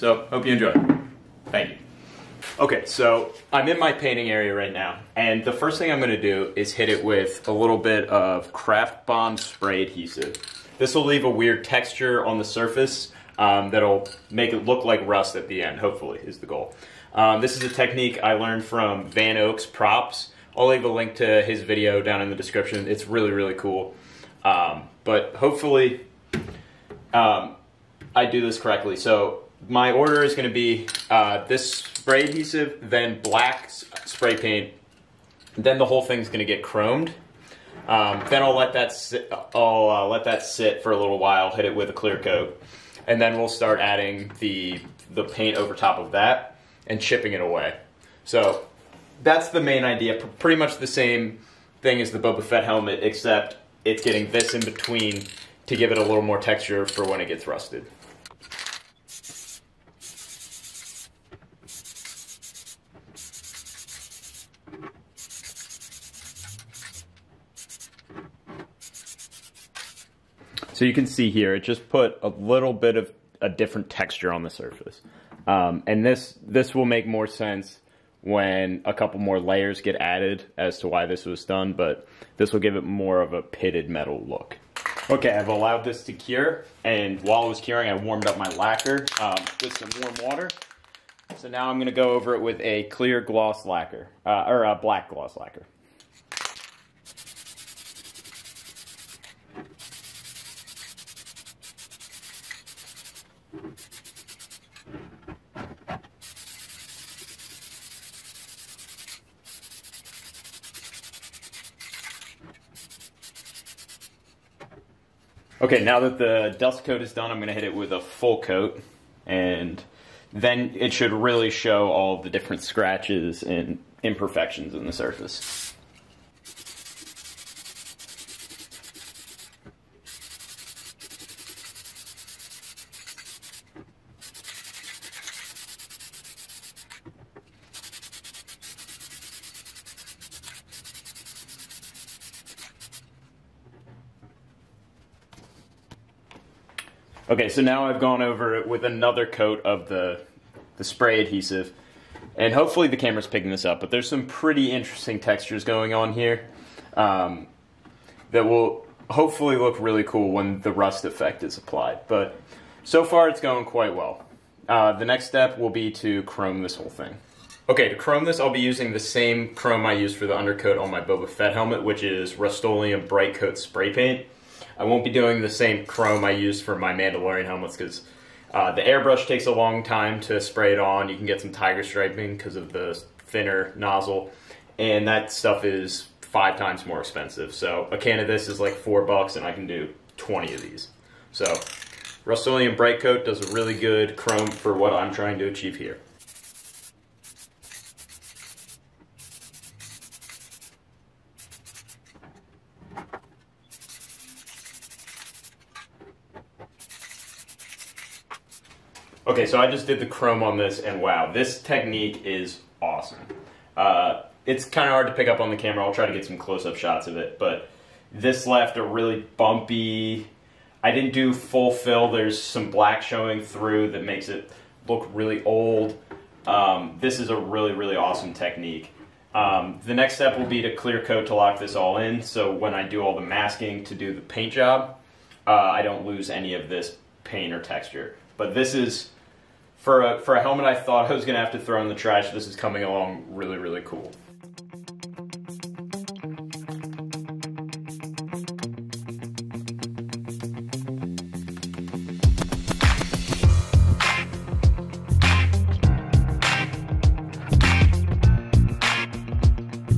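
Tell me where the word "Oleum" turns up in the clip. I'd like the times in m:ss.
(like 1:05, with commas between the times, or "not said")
2:52, 3:12.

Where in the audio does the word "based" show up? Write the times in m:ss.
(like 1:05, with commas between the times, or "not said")
not said.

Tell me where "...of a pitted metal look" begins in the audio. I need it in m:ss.
1:23.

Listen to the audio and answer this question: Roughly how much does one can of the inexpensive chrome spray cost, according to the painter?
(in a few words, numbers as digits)
$4.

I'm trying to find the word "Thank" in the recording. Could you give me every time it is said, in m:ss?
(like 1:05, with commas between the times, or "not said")
0:01.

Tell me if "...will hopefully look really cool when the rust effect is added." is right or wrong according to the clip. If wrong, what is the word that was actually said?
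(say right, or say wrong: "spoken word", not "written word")
wrong: "applied", not "added".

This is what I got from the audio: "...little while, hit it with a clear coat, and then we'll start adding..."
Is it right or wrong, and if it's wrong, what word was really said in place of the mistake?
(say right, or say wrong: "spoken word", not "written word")
right.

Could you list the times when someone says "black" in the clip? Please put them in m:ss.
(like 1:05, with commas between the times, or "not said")
0:33, 1:34, 3:42.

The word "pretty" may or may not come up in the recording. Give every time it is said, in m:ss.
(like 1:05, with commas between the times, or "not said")
0:50, 2:34.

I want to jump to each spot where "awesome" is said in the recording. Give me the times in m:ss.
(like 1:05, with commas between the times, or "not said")
3:32, 3:47.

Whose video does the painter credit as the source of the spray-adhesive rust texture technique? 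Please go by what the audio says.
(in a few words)
VanOaks Props.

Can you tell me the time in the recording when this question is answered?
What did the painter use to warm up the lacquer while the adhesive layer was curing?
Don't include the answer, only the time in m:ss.
1:30.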